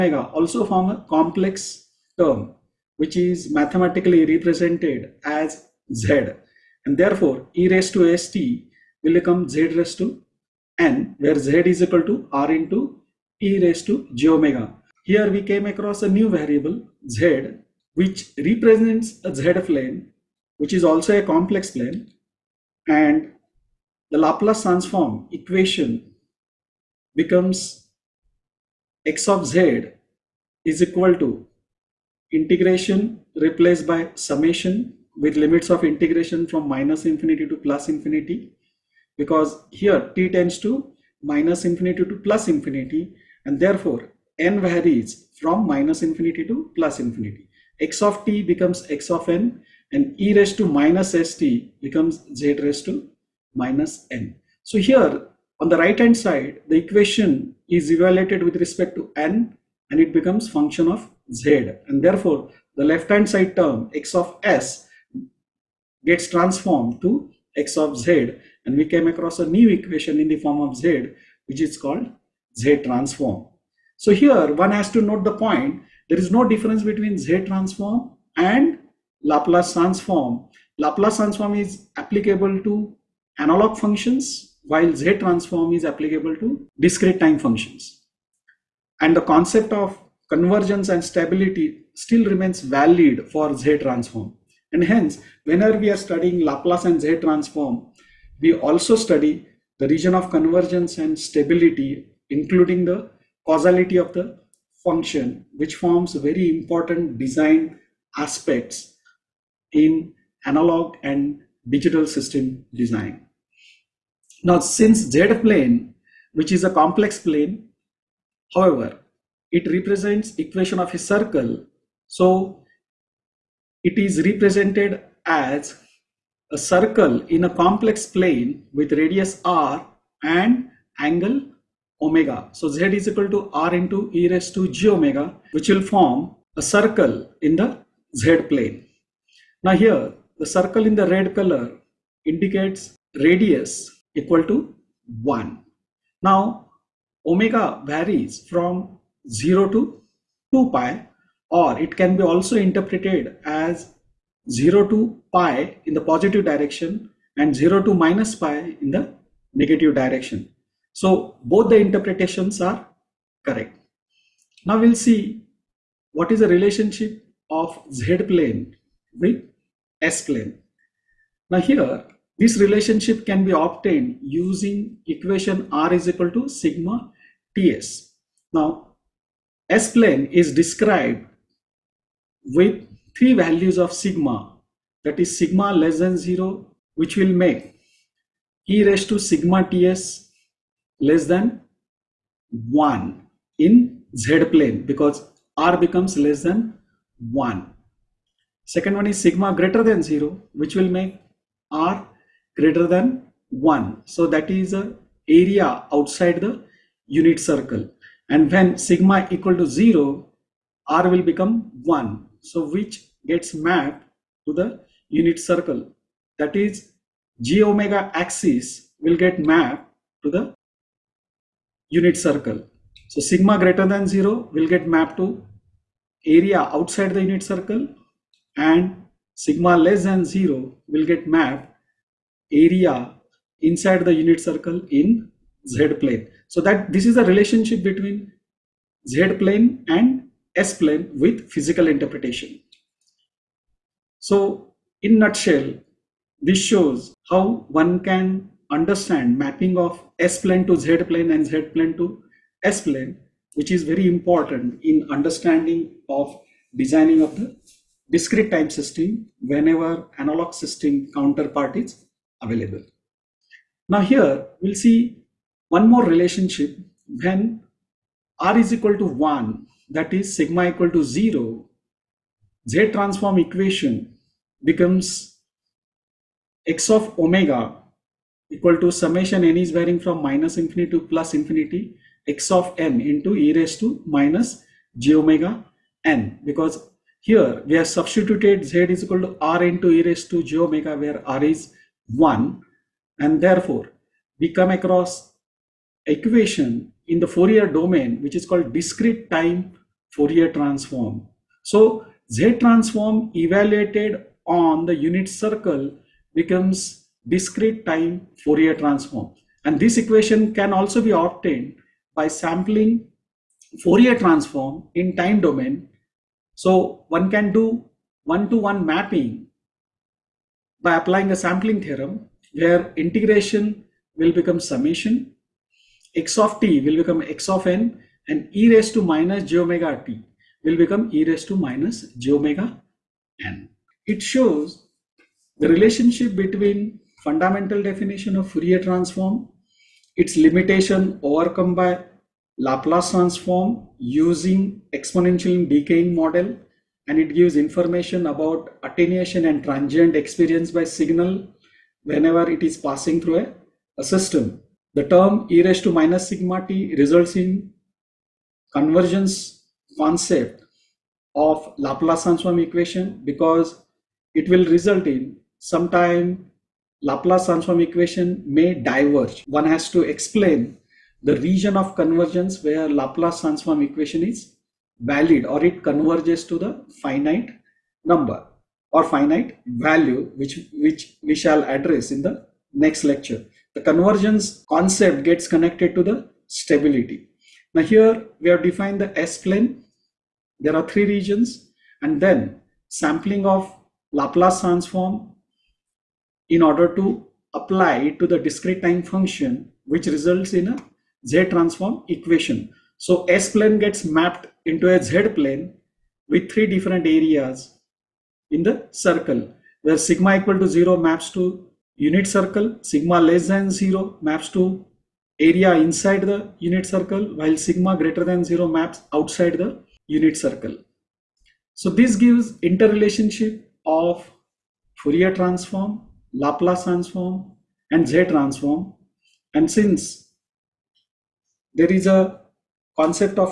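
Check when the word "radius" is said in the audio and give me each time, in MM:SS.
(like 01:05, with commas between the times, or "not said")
02:08, 02:23.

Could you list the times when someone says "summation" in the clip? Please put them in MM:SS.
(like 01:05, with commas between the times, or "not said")
00:34, 04:38, 05:24.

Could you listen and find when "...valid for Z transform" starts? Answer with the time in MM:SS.
01:32.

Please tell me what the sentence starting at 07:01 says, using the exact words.
So this gives interrelationship of Fourier transform Laplace transform and Z transform.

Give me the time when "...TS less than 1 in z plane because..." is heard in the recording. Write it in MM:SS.
03:09.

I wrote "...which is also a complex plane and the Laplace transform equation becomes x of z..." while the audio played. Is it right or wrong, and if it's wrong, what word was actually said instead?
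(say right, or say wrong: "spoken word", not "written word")
right.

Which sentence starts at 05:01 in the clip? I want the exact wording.
So Z transform evaluated on the unit circle becomes discrete time Fourier transform.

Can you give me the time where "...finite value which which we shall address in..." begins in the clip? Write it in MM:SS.
06:19.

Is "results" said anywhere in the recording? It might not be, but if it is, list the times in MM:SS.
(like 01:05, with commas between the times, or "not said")
05:56, 06:04, 06:40.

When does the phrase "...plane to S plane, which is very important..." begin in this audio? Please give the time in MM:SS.
04:11.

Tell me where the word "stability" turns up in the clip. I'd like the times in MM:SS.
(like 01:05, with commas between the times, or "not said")
01:31, 01:41, 06:26.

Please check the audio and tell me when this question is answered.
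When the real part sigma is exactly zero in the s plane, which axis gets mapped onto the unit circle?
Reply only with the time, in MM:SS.
03:37.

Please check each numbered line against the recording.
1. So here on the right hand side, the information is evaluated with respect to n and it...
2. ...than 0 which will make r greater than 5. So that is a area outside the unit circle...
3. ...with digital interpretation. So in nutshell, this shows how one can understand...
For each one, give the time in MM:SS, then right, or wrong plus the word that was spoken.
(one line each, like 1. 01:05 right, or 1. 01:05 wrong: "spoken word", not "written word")
1. 00:54 wrong: "equation", not "information"
2. 03:19 wrong: "1", not "5"
3. 04:01 wrong: "physical", not "digital".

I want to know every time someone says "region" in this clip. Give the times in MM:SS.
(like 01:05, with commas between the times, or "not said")
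01:39, 06:11, 06:31.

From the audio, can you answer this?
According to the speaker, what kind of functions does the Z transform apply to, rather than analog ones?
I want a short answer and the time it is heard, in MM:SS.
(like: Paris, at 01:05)
Discrete time functions, at 01:26.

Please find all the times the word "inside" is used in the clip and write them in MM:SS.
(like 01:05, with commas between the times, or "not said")
03:53, 06:55.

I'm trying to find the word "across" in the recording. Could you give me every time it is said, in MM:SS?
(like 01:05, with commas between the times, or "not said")
00:15, 01:09, 04:54.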